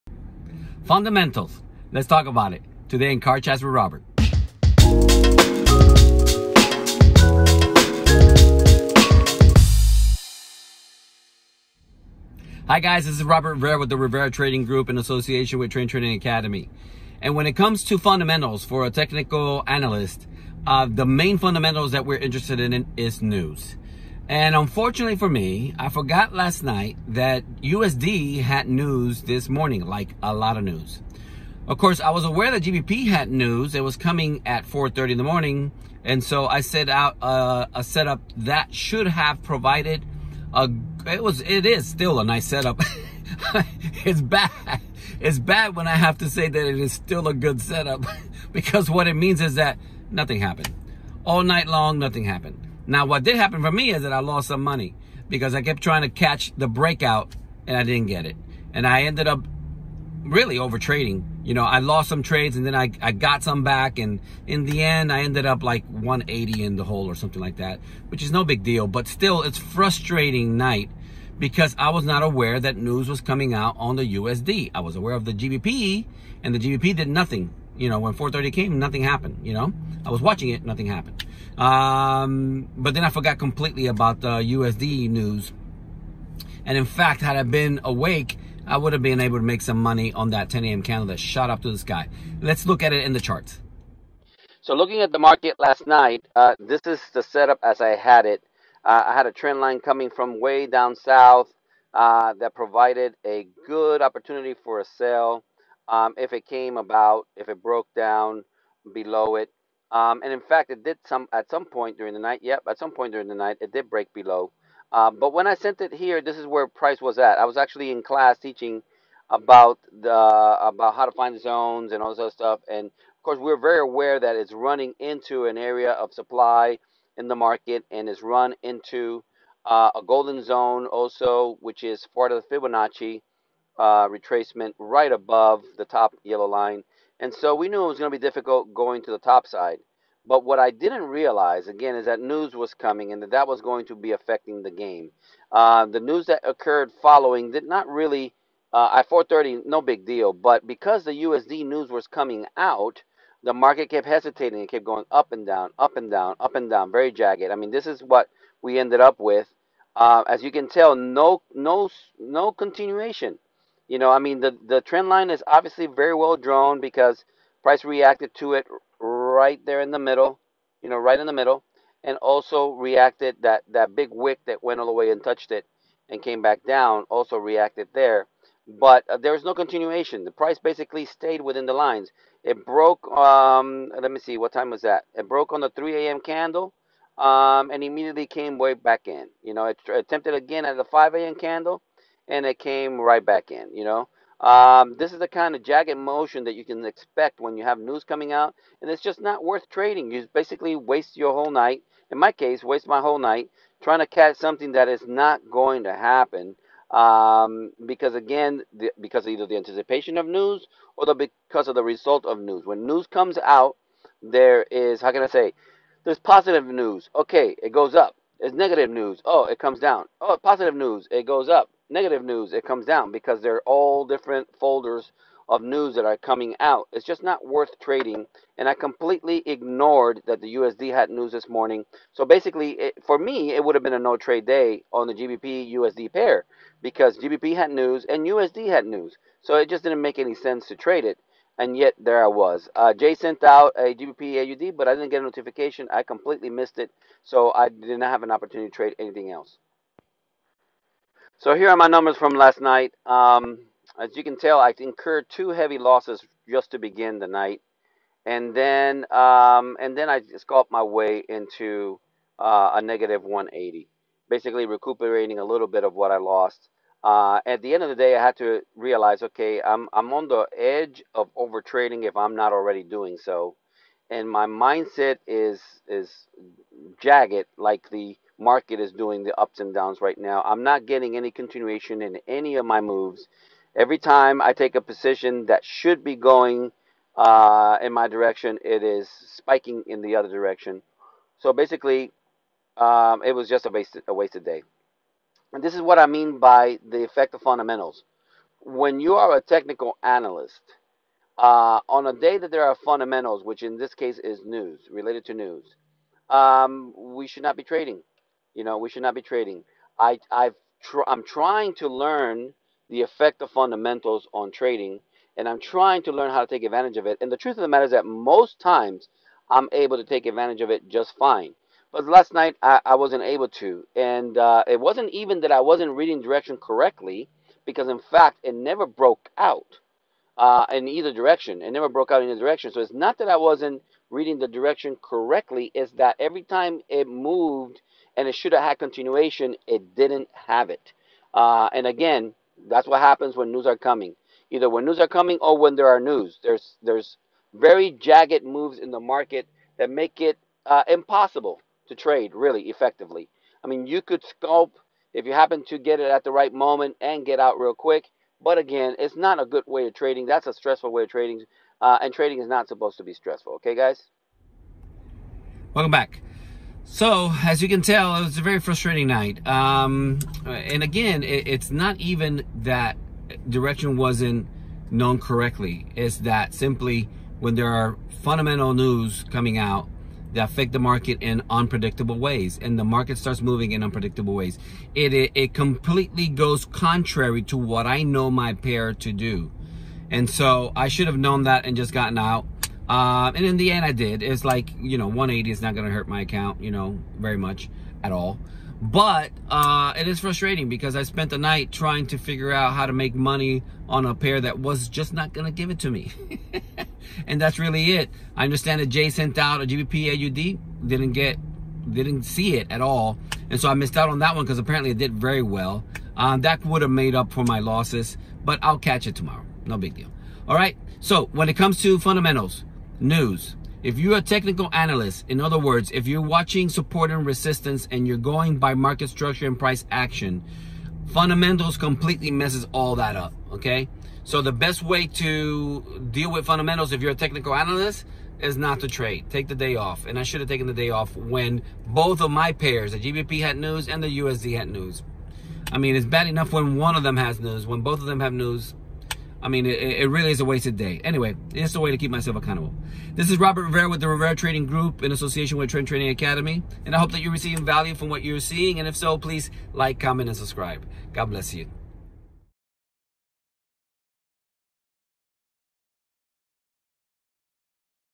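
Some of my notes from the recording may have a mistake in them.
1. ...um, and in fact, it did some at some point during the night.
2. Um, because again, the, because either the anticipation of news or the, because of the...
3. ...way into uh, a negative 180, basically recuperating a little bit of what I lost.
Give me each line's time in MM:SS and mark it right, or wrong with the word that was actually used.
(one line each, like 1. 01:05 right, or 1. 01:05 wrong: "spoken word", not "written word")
1. 01:49 right
2. 03:26 right
3. 04:20 right.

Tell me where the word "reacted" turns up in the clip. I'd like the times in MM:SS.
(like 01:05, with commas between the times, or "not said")
02:47, 02:52, 02:57.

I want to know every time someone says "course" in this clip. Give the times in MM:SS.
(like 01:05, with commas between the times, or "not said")
00:31, 02:03.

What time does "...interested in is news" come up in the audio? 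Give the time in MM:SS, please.
00:22.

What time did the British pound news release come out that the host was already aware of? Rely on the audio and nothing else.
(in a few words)
4:30 in the morning.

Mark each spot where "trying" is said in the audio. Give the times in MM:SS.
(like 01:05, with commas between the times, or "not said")
00:55, 03:23, 05:11, 05:15, 06:41.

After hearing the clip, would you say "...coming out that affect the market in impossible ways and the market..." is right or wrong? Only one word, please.
wrong.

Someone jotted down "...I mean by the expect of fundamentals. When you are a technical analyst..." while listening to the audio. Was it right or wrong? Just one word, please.
wrong.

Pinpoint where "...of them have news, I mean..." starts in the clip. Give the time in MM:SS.
07:27.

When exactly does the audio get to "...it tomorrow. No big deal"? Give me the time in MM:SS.
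06:59.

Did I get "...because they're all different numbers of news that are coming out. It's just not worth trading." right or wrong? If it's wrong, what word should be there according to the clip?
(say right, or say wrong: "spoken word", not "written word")
wrong: "folders", not "numbers".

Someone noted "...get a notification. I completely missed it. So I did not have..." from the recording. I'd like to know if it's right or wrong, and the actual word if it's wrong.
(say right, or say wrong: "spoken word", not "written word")
right.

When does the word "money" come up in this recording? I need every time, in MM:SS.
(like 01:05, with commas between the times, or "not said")
00:54, 01:29, 06:43.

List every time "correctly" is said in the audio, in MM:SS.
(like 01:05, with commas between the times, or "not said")
05:26, 05:35, 06:15.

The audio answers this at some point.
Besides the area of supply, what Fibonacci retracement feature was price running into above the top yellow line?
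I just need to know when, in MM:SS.
02:10.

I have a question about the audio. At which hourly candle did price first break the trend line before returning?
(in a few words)
3 a.m.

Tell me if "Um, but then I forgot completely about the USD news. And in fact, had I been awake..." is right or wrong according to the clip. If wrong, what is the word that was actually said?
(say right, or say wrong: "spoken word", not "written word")
right.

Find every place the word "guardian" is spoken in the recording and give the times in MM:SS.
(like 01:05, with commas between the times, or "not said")
not said.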